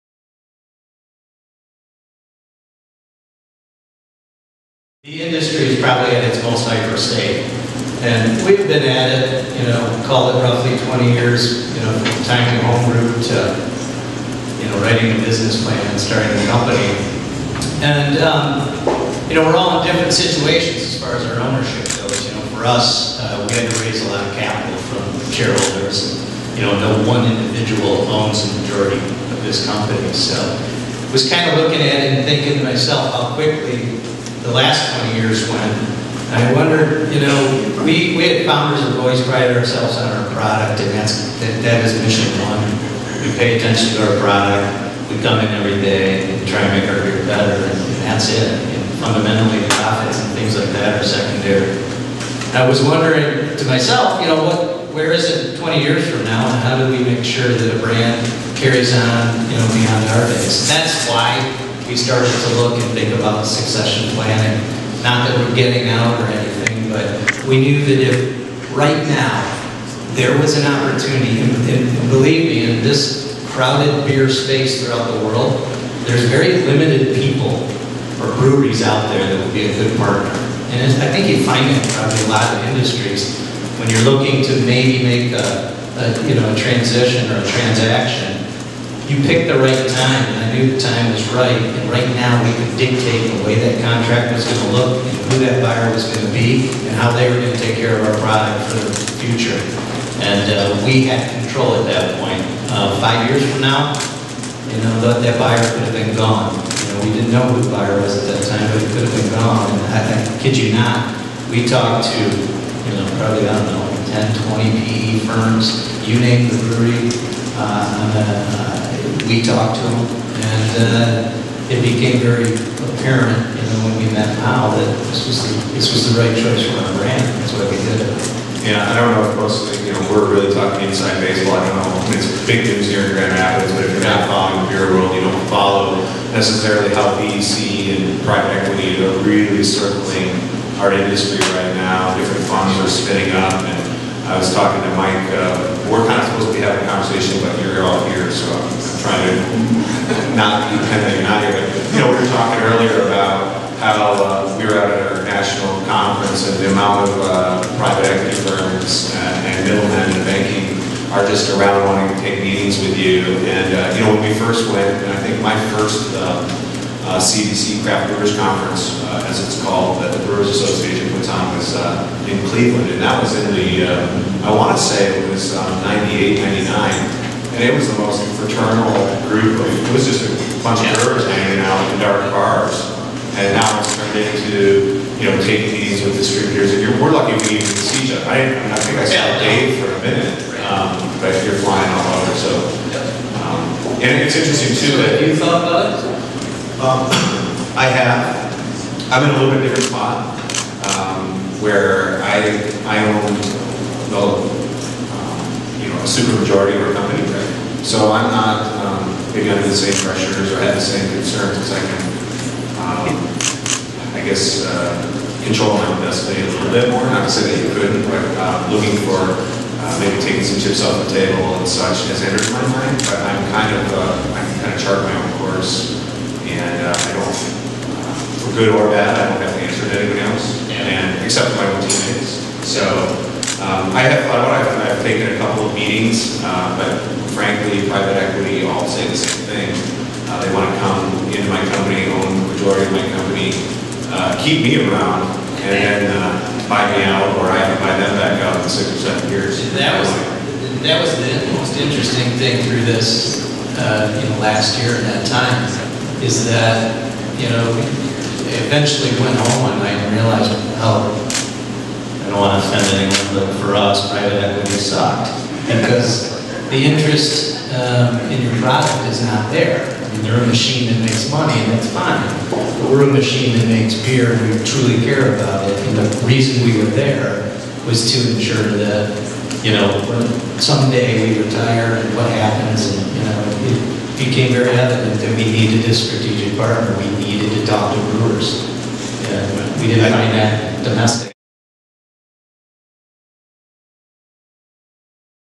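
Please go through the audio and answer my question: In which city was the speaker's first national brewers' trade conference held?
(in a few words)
Cleveland.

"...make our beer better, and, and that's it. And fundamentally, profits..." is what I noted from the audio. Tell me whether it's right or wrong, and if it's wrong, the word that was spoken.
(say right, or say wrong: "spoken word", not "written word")
right.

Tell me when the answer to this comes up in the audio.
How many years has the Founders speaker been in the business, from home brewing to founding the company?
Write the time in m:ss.
0:10.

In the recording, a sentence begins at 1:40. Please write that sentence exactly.
And uh, we had control at that point.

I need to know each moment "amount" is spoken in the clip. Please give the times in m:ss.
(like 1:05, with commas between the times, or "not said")
2:36.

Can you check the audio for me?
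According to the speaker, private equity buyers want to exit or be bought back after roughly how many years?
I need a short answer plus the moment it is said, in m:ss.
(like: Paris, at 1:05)
6 or 7 years, at 4:08.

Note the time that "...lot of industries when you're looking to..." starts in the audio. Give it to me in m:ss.
1:22.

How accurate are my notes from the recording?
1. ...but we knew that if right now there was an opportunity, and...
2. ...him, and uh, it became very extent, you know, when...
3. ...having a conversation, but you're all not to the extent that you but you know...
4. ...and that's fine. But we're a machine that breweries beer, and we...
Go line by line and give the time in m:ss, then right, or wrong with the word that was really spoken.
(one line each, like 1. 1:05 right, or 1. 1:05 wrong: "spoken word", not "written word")
1. 1:06 right
2. 1:59 wrong: "apparent", not "extent"
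3. 2:26 right
4. 4:31 wrong: "makes", not "breweries".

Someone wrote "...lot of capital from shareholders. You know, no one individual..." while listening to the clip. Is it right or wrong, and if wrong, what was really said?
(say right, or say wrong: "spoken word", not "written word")
right.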